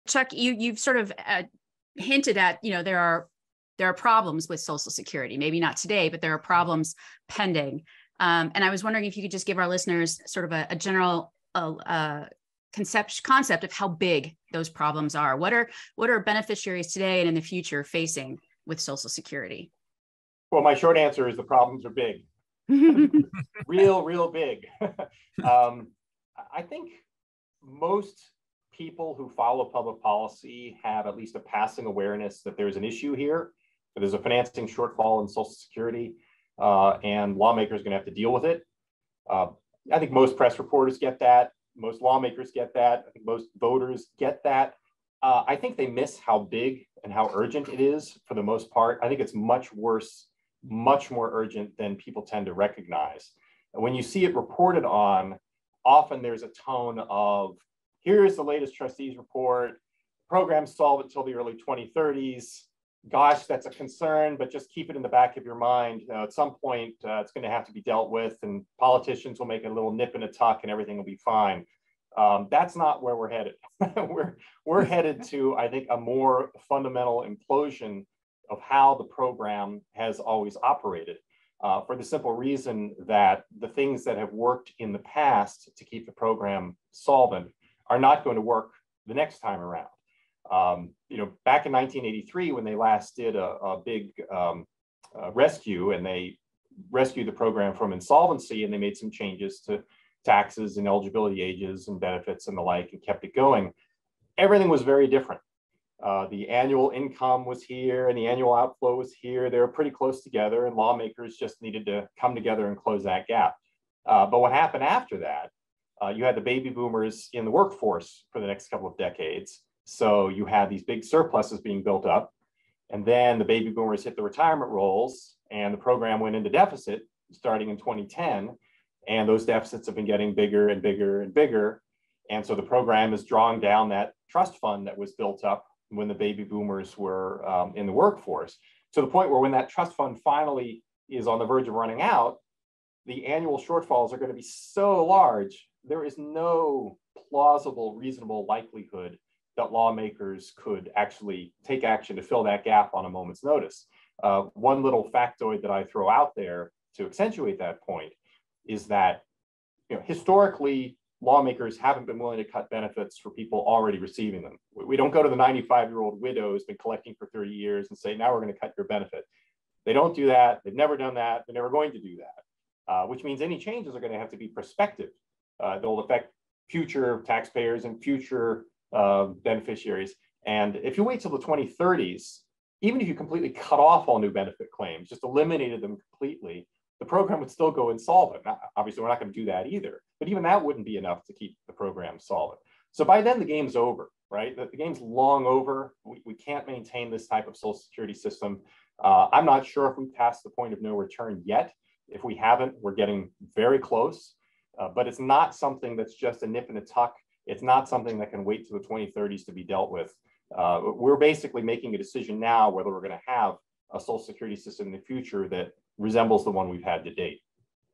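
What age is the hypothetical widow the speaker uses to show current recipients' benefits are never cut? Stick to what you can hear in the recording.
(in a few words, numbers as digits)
95.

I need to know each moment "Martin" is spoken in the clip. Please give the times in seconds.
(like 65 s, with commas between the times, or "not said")
not said.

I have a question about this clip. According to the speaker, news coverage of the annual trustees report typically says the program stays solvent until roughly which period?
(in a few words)
early 2030s.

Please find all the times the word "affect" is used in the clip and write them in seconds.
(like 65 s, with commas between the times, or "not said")
175 s.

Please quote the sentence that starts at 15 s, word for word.
What are what are beneficiaries today and in the future facing with Social Security?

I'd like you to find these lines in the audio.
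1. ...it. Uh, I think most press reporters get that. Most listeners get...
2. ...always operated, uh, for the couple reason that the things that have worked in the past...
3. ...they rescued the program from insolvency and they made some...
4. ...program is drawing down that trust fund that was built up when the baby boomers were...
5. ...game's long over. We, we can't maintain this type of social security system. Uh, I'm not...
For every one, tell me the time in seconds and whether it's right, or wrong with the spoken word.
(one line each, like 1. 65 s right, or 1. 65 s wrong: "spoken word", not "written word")
1. 38 s wrong: "lawmakers", not "listeners"
2. 80 s wrong: "simple", not "couple"
3. 96 s right
4. 132 s right
5. 194 s right.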